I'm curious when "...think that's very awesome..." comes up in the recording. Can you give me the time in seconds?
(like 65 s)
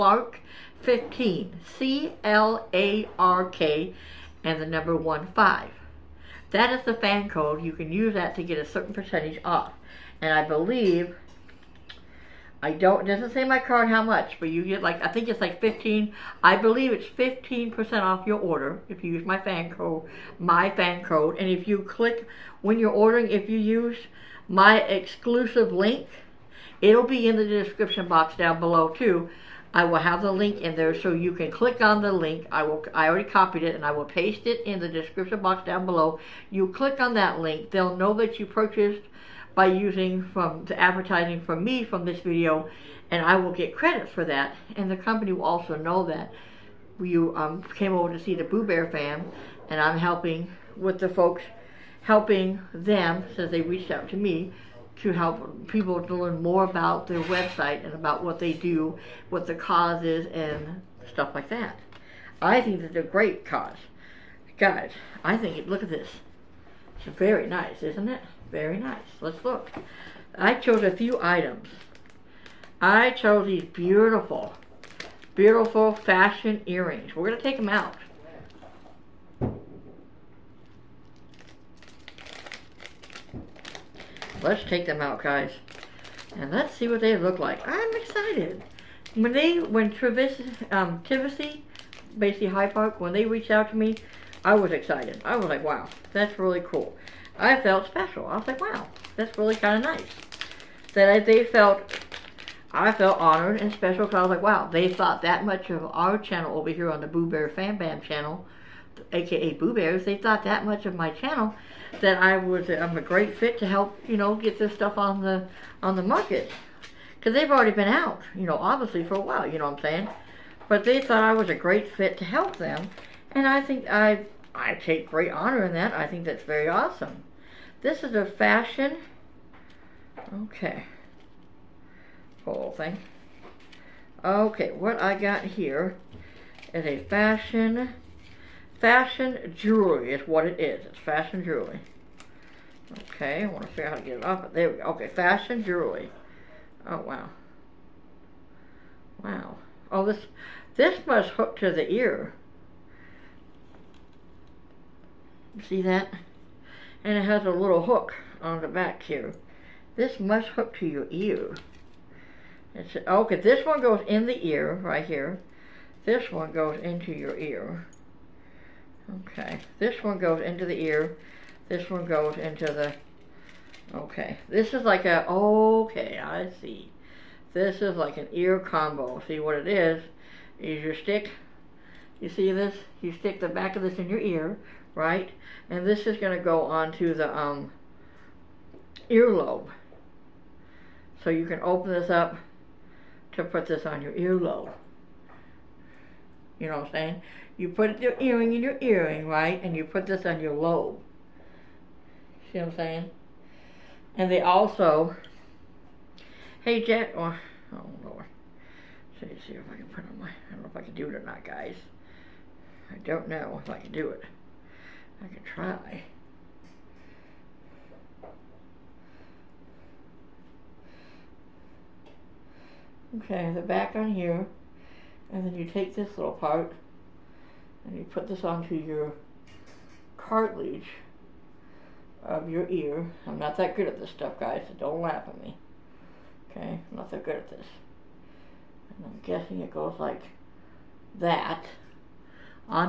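126 s.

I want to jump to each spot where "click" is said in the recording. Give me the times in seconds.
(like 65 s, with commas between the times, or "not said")
21 s, 31 s, 36 s.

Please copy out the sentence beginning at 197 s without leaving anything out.
you put your earring in your earring, right?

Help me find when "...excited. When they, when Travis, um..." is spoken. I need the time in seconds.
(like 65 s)
87 s.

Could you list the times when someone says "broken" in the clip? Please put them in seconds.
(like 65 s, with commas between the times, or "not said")
not said.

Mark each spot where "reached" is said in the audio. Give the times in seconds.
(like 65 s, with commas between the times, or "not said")
53 s, 93 s.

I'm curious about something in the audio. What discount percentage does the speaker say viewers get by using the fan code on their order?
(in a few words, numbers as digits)
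15%.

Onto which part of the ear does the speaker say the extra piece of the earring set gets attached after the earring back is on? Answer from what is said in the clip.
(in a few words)
Cartilage.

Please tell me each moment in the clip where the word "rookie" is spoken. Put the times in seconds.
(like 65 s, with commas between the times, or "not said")
not said.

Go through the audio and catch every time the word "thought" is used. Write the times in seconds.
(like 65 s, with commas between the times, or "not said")
104 s, 110 s, 121 s.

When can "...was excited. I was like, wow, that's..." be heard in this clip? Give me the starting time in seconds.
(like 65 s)
94 s.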